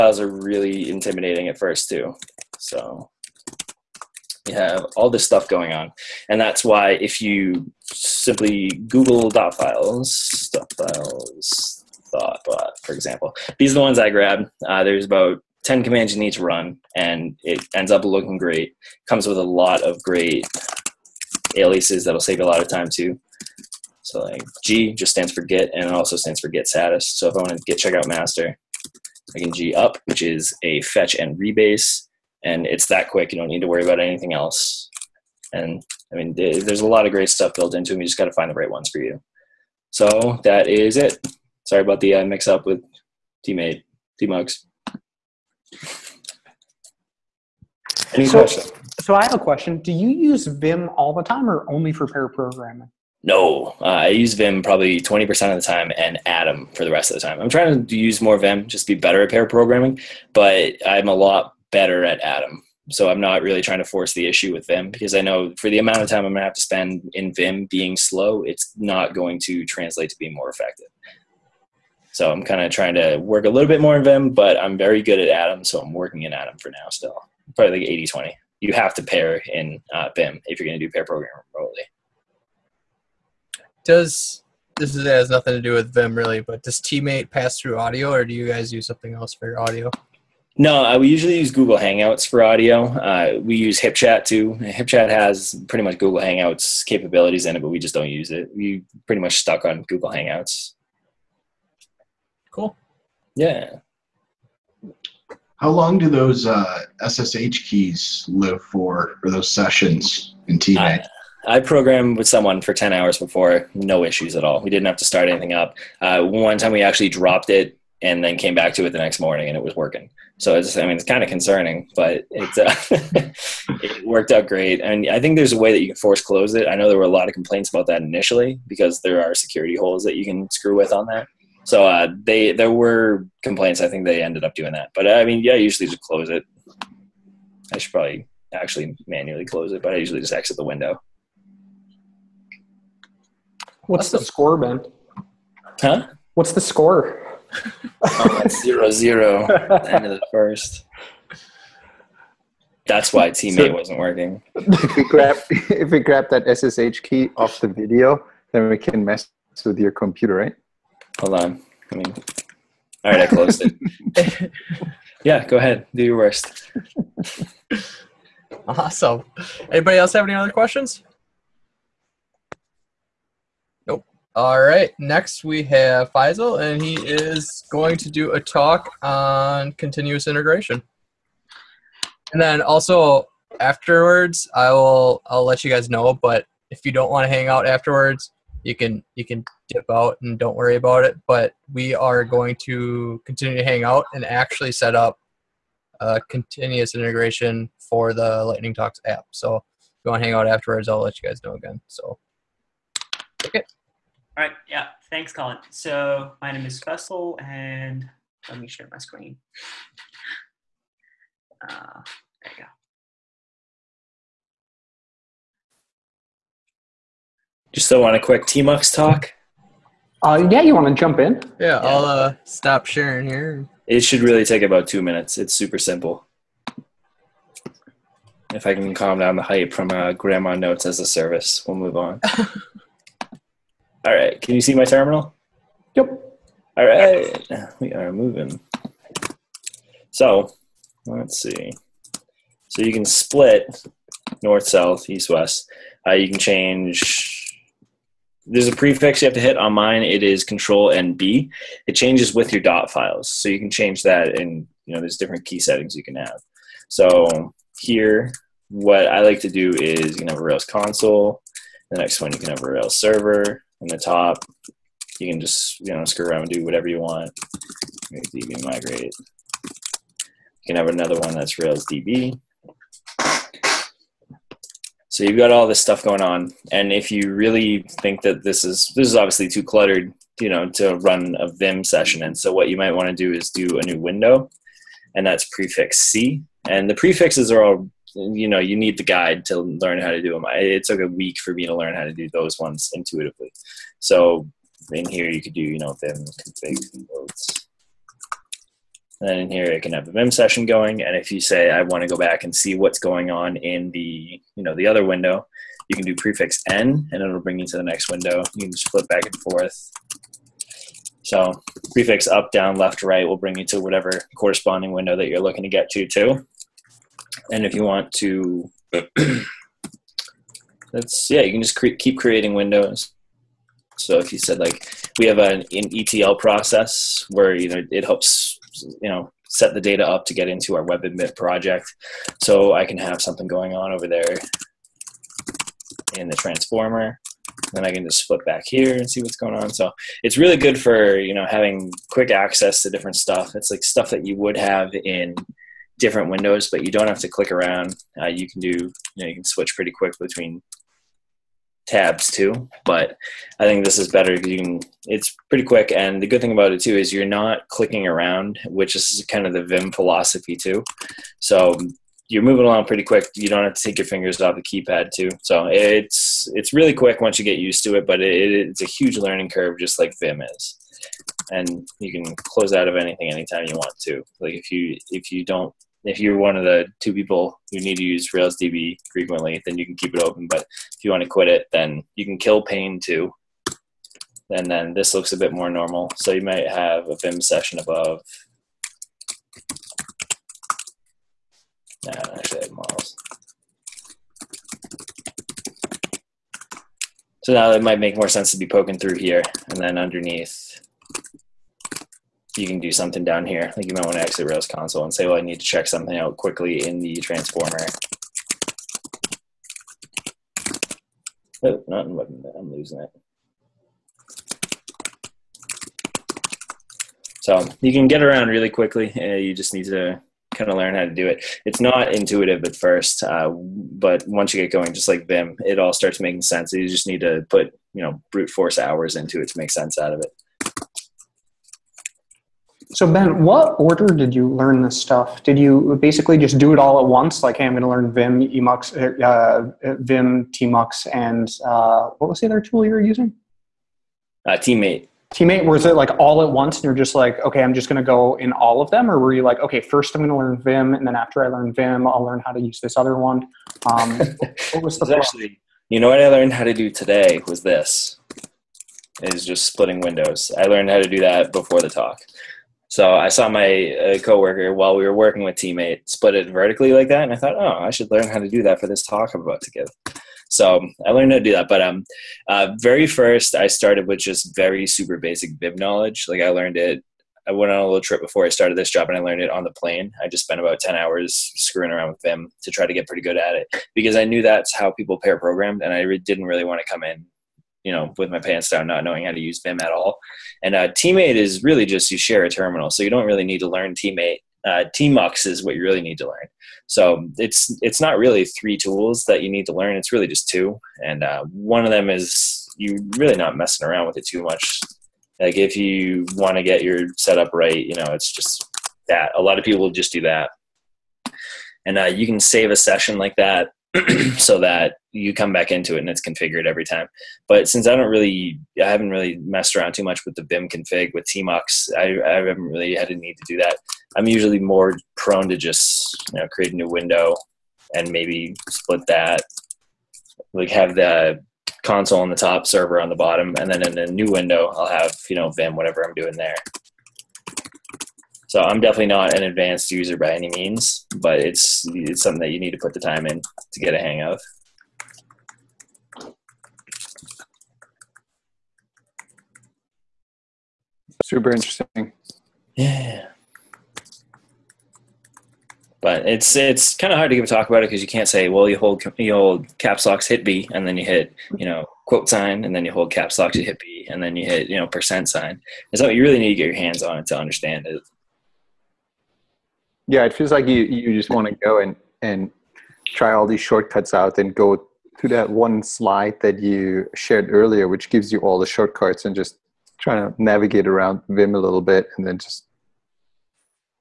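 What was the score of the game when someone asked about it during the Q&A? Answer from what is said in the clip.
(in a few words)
0-0.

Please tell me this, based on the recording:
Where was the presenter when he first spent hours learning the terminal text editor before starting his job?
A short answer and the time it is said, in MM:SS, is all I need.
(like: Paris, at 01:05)
on the plane, at 07:59.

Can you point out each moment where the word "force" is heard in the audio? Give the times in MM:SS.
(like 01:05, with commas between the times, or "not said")
01:03, 02:05, 07:08.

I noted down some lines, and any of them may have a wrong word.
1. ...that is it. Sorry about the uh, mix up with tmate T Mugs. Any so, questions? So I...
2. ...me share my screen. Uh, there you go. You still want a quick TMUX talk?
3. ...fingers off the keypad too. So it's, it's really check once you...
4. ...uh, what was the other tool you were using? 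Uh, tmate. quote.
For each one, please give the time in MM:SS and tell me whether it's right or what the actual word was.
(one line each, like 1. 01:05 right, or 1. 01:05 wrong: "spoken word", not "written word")
1. 00:40 right
2. 03:28 right
3. 06:04 wrong: "quick", not "check"
4. 07:21 wrong: "tmate", not "quote".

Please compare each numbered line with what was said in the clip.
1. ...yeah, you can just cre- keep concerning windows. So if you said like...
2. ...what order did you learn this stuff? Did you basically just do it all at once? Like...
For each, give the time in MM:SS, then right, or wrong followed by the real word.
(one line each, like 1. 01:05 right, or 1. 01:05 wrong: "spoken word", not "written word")
1. 05:21 wrong: "creating", not "concerning"
2. 07:13 right.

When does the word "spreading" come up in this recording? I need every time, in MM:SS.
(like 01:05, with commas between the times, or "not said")
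not said.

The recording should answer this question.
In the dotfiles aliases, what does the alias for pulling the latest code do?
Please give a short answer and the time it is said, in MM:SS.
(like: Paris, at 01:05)
fetch and rebase, at 00:30.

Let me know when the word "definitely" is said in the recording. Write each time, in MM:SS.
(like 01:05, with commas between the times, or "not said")
08:58.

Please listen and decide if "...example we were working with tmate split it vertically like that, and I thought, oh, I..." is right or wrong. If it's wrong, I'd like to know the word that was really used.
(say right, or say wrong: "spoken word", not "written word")
wrong: "while", not "example".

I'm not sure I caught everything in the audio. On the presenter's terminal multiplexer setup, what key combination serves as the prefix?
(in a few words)
Control and B.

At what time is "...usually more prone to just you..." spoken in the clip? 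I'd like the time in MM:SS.
08:44.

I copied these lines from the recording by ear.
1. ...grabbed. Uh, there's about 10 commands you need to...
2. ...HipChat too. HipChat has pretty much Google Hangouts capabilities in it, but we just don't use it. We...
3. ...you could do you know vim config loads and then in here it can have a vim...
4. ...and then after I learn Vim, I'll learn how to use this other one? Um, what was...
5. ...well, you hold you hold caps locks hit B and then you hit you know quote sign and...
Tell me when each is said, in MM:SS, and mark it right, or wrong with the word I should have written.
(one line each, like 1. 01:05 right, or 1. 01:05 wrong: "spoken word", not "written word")
1. 00:14 right
2. 01:33 right
3. 04:55 right
4. 07:30 right
5. 09:18 right.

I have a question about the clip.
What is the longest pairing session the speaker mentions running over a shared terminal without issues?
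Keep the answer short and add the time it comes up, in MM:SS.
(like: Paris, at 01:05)
10 hours, at 01:52.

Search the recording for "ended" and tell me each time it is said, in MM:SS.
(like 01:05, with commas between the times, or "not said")
02:14.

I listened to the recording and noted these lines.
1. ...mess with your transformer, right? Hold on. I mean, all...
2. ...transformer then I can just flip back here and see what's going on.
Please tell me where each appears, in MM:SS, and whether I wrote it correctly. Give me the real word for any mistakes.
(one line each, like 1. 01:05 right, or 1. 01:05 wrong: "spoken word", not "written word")
1. 02:39 wrong: "computer", not "transformer"
2. 05:36 right.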